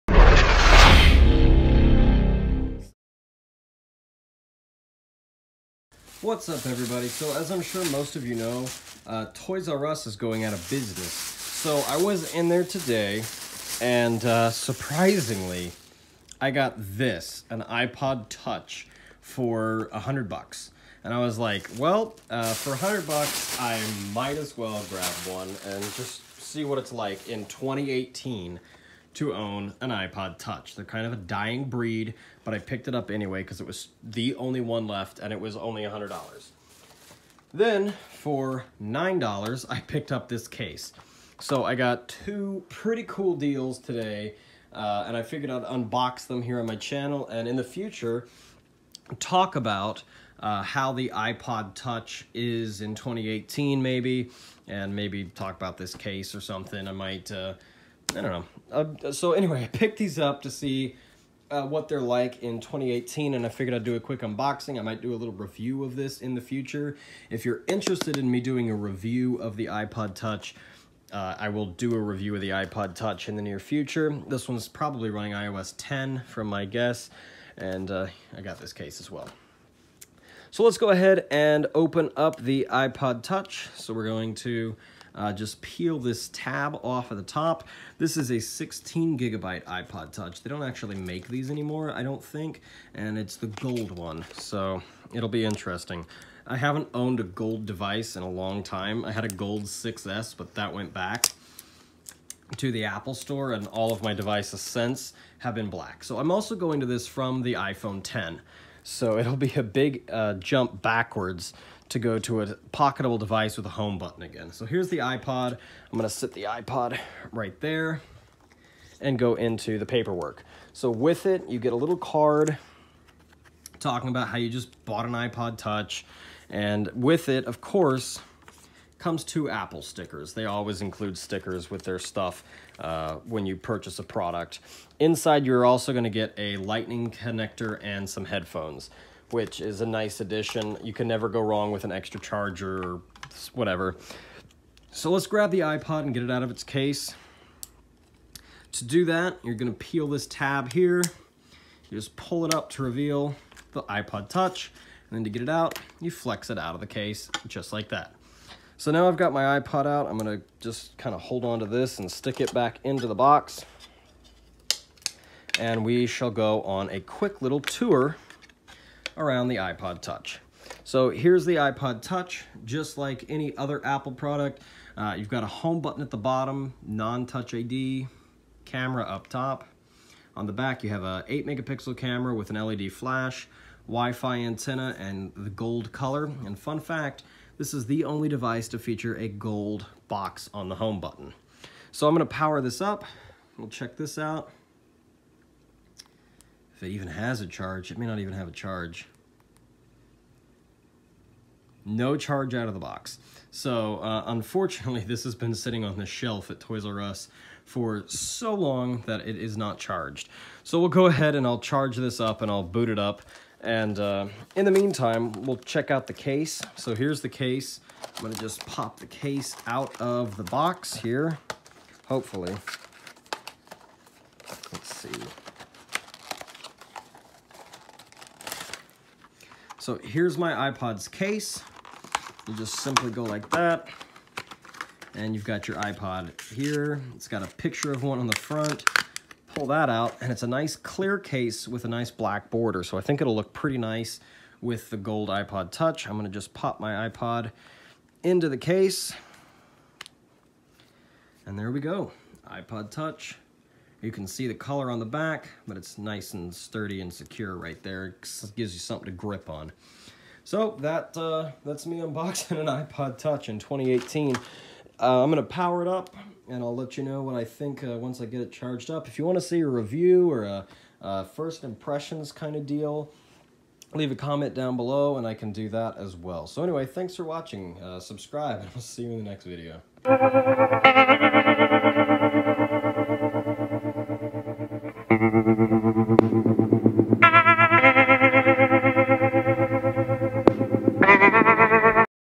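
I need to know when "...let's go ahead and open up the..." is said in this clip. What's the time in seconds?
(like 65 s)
80 s.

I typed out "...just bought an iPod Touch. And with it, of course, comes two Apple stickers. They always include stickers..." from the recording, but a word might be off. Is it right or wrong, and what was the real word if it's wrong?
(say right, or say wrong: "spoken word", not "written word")
right.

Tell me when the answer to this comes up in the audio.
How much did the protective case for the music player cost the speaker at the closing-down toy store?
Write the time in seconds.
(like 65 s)
38 s.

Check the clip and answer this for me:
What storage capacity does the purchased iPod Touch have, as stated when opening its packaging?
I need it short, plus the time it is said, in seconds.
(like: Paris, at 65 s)
16 gigabytes, at 88 s.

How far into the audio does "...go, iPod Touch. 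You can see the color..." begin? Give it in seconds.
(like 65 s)
251 s.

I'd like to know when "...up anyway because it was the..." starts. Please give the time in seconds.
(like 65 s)
32 s.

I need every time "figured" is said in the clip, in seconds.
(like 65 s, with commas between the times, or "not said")
45 s, 63 s.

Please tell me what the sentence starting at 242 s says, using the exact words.
So I think it'll look pretty nice with the gold iPod Touch.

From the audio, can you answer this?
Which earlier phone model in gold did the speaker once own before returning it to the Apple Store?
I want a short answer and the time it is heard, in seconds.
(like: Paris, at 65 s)
6S, at 99 s.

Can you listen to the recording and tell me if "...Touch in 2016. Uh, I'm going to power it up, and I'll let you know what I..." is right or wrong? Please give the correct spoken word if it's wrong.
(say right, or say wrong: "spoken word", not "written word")
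wrong: "2018", not "2016".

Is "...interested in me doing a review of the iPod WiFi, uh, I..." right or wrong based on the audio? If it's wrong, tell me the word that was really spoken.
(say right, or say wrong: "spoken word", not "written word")
wrong: "Touch", not "WiFi".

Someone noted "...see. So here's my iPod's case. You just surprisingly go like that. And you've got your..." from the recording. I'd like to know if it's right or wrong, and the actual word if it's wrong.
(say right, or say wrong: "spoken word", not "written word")
wrong: "simply", not "surprisingly".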